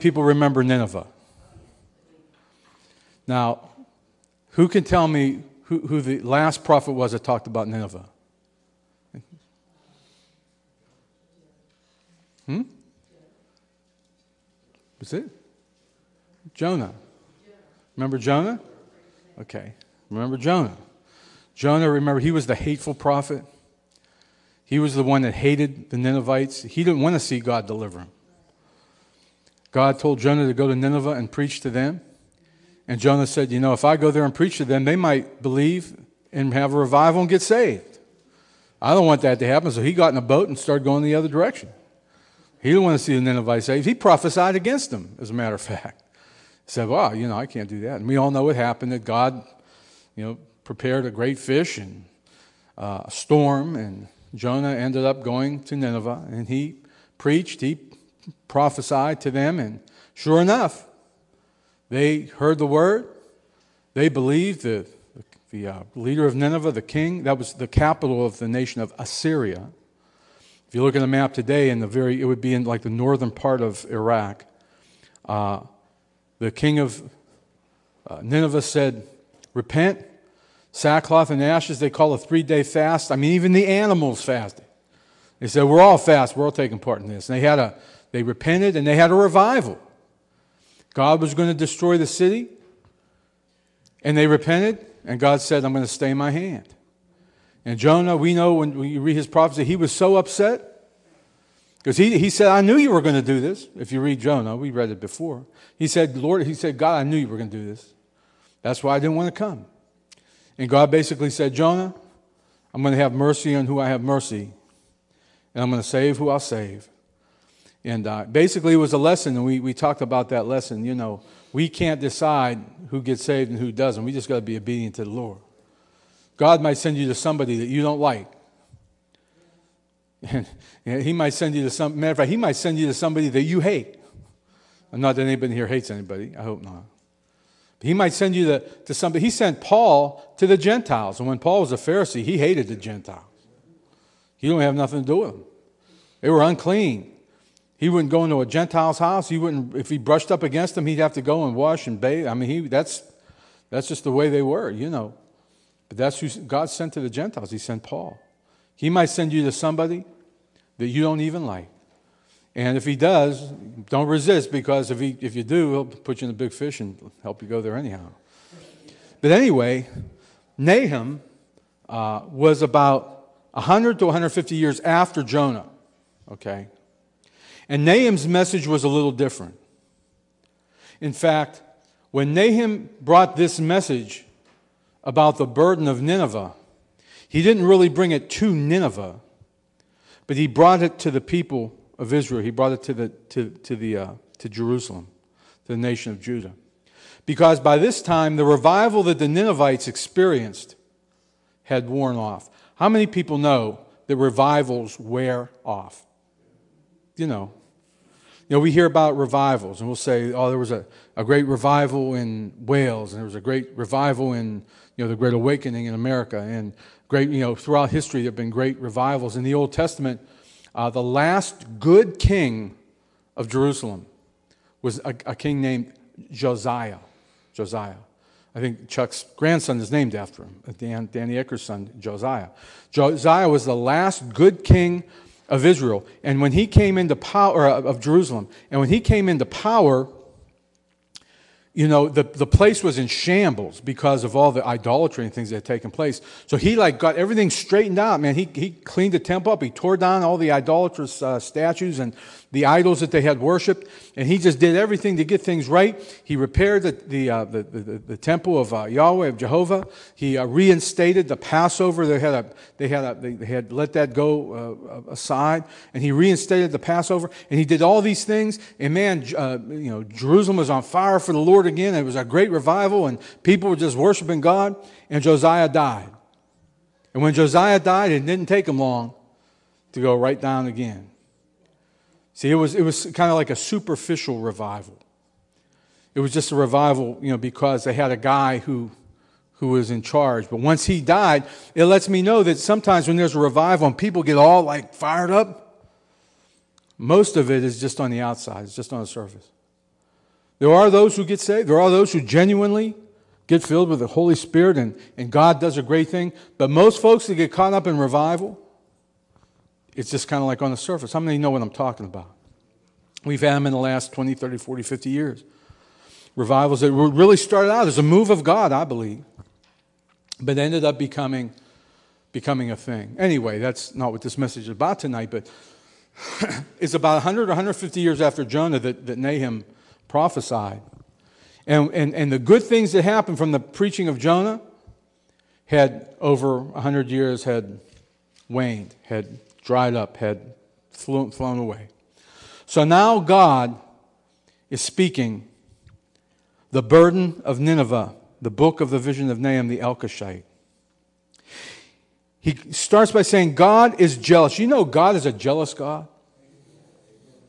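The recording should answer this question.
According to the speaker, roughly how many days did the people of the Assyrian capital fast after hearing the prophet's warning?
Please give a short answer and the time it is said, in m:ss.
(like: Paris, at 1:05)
3, at 1:22.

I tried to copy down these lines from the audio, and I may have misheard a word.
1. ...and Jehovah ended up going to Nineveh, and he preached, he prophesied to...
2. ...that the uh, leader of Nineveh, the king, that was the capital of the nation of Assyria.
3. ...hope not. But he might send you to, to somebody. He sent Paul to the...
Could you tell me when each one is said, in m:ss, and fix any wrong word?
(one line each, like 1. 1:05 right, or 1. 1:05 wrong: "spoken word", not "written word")
1. 0:53 wrong: "Jonah", not "Jehovah"
2. 1:04 right
3. 2:16 right.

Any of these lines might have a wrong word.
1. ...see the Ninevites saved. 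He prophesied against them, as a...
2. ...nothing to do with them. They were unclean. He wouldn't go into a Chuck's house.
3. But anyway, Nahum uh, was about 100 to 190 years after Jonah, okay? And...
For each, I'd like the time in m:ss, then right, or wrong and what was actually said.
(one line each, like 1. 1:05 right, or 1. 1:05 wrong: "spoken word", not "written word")
1. 0:43 right
2. 2:24 wrong: "Gentile", not "Chuck"
3. 2:49 wrong: "150", not "190".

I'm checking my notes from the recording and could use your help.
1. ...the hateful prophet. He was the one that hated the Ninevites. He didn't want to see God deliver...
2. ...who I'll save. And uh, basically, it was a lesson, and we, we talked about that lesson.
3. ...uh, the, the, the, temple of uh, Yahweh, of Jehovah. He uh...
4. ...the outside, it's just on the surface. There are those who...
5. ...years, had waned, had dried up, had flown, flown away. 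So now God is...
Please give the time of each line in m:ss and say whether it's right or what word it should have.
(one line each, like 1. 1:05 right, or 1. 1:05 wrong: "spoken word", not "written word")
1. 0:22 right
2. 1:56 right
3. 4:17 right
4. 4:58 right
5. 5:37 right.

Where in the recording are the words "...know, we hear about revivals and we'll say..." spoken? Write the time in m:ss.
3:28.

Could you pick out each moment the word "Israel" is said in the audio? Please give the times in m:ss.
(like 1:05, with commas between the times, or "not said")
3:12, 3:55.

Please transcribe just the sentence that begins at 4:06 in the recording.
So he like got everything straightened out, man.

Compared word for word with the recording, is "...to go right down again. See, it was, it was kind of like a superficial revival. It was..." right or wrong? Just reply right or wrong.
right.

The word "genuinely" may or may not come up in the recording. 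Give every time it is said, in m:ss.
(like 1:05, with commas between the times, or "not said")
5:02.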